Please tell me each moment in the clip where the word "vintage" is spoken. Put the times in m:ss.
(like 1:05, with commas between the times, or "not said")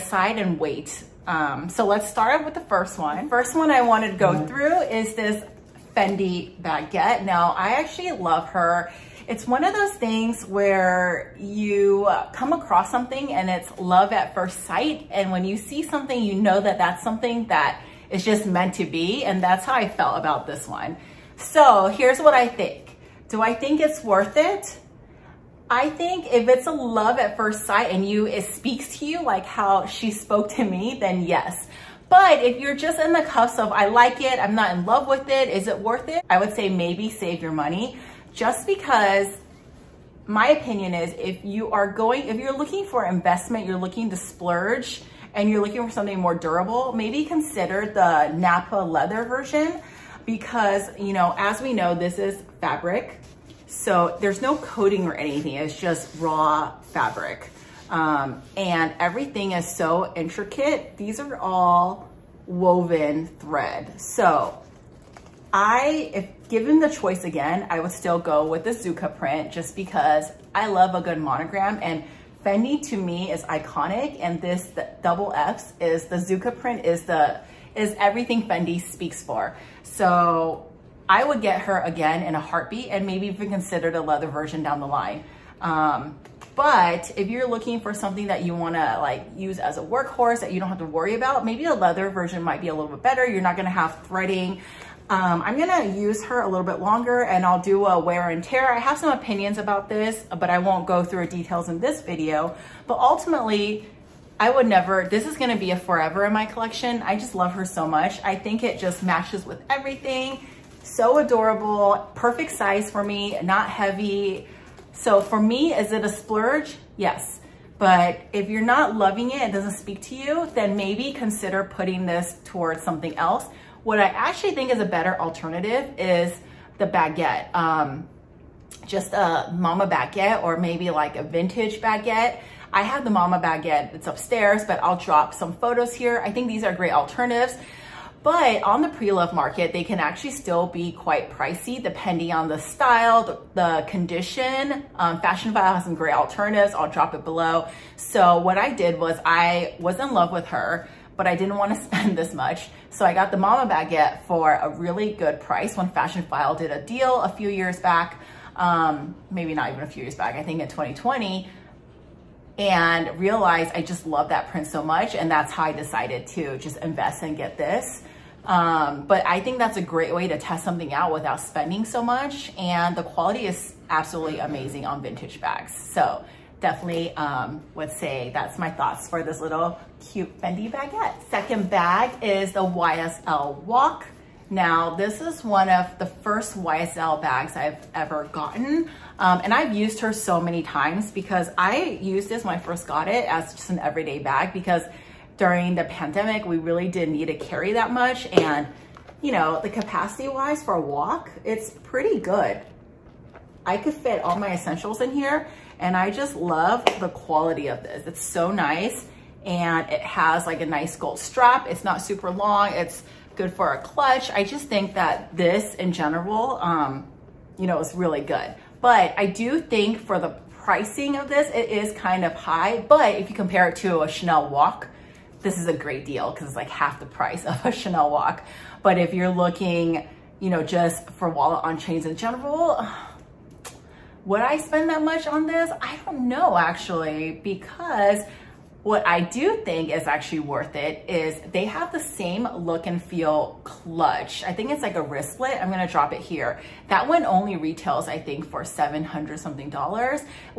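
2:11, 2:55.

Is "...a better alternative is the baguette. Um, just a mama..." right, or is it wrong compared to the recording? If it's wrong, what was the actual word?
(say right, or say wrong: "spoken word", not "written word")
right.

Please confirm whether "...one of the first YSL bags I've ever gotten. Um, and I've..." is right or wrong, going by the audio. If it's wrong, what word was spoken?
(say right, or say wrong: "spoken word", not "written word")
right.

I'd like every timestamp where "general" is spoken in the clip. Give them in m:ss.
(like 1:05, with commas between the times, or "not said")
3:35, 3:52.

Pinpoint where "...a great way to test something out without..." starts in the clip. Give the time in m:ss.
2:49.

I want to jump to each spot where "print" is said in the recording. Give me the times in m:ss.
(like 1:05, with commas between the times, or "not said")
1:09, 1:16, 2:44.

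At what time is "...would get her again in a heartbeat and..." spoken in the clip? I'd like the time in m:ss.
1:21.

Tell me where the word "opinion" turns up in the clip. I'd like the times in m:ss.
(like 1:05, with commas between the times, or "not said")
0:40, 1:39.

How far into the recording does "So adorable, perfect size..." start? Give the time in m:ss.
1:50.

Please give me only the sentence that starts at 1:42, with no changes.
But ultimately, I would never, this is going to be a forever in my collection.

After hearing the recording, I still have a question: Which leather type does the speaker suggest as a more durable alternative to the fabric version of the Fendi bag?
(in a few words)
Napa leather.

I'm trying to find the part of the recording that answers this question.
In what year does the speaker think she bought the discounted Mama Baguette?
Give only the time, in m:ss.
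2:40.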